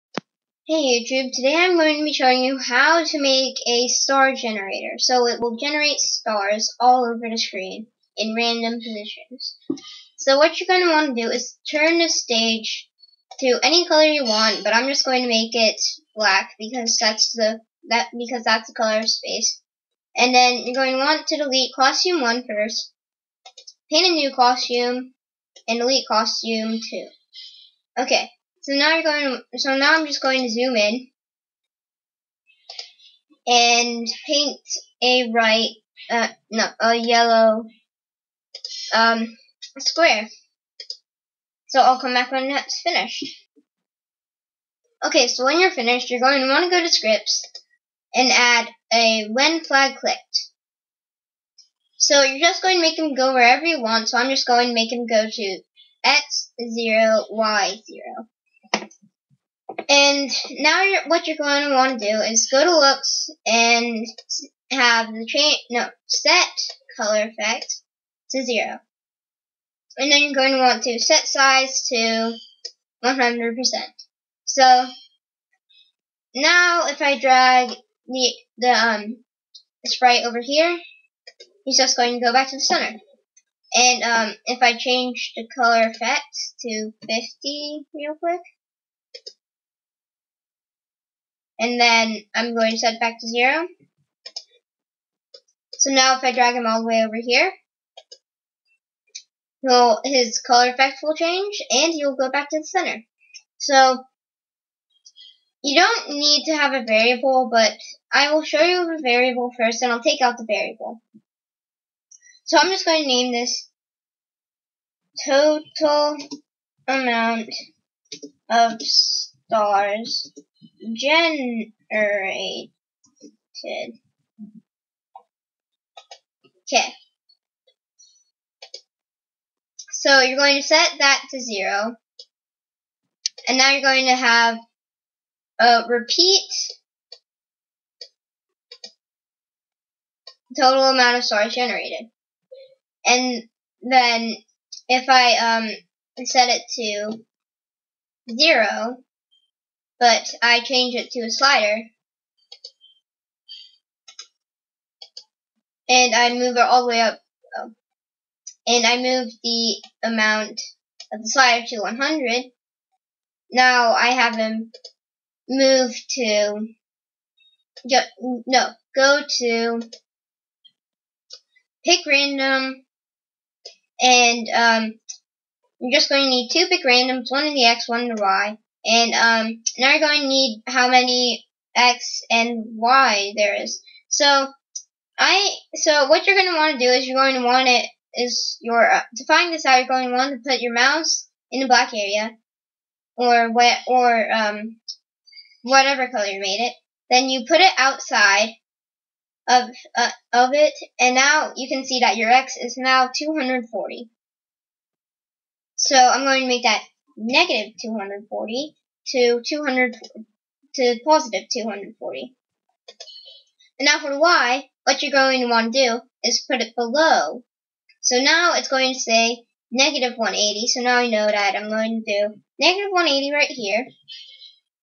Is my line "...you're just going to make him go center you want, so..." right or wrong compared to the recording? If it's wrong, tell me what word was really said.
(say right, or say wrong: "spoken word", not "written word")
wrong: "wherever", not "center".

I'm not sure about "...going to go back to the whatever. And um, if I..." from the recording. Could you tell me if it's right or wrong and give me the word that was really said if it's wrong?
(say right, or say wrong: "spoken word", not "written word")
wrong: "center", not "whatever".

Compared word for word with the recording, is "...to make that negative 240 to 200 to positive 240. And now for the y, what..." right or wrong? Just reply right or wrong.
right.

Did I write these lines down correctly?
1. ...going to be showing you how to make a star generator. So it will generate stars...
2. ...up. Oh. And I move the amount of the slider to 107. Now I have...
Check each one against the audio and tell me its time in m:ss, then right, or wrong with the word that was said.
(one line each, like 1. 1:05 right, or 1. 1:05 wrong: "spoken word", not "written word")
1. 0:01 right
2. 2:37 wrong: "100", not "107".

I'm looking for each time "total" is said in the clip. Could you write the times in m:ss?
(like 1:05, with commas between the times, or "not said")
1:55, 2:20.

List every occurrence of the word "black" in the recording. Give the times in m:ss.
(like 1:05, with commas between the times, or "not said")
0:16, 3:11.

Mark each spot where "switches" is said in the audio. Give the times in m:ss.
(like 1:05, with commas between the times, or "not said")
not said.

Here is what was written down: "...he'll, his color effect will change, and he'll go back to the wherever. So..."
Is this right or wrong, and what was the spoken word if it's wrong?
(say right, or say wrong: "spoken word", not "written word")
wrong: "center", not "wherever".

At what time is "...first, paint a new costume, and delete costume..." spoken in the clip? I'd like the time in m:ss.
0:22.